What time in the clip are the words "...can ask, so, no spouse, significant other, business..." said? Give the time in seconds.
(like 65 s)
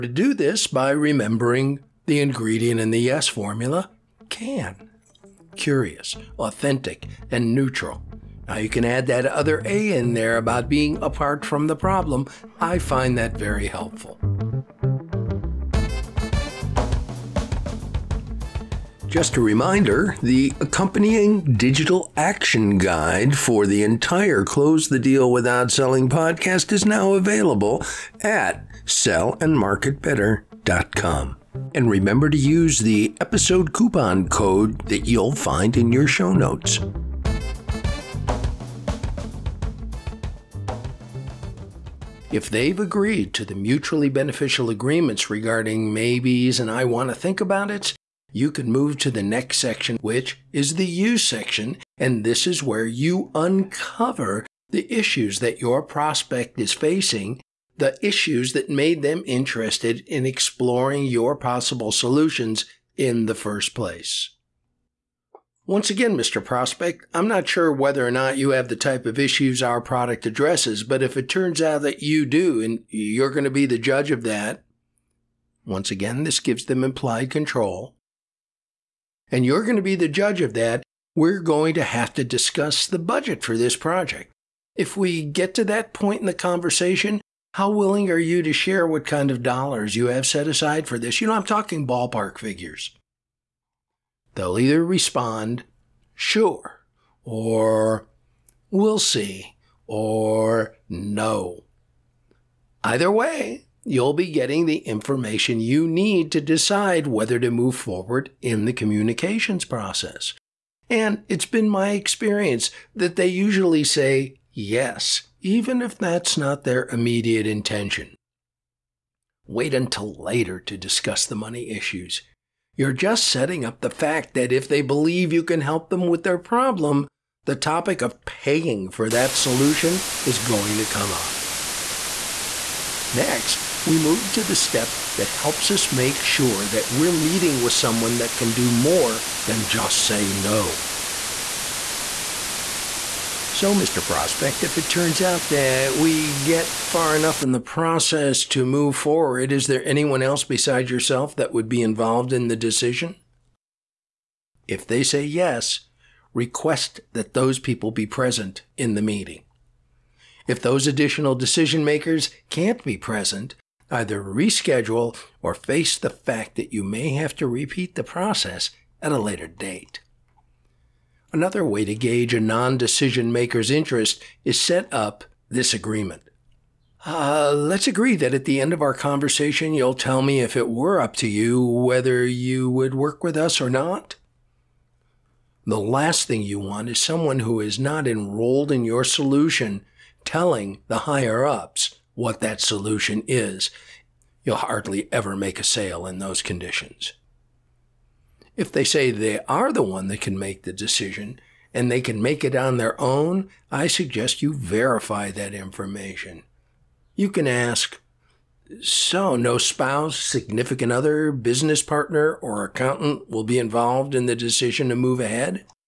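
207 s.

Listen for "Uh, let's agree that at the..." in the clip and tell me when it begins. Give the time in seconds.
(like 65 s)
177 s.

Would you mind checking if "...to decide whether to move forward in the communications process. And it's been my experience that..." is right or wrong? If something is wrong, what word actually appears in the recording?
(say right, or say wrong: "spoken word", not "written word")
right.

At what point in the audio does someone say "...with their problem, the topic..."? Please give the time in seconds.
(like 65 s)
126 s.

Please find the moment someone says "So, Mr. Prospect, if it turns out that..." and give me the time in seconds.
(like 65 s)
143 s.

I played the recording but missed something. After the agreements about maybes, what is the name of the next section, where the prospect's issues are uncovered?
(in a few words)
The you section.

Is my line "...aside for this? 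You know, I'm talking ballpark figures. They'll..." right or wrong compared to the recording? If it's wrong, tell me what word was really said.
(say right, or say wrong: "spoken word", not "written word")
right.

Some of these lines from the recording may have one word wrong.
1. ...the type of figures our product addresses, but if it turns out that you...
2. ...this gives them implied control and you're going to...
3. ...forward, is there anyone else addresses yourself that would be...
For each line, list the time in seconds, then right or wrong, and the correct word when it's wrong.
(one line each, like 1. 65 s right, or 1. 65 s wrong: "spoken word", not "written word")
1. 68 s wrong: "issues", not "figures"
2. 76 s right
3. 148 s wrong: "besides", not "addresses".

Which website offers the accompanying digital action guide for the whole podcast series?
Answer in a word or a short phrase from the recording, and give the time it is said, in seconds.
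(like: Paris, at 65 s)
sellandmarketbetter.com, at 28 s.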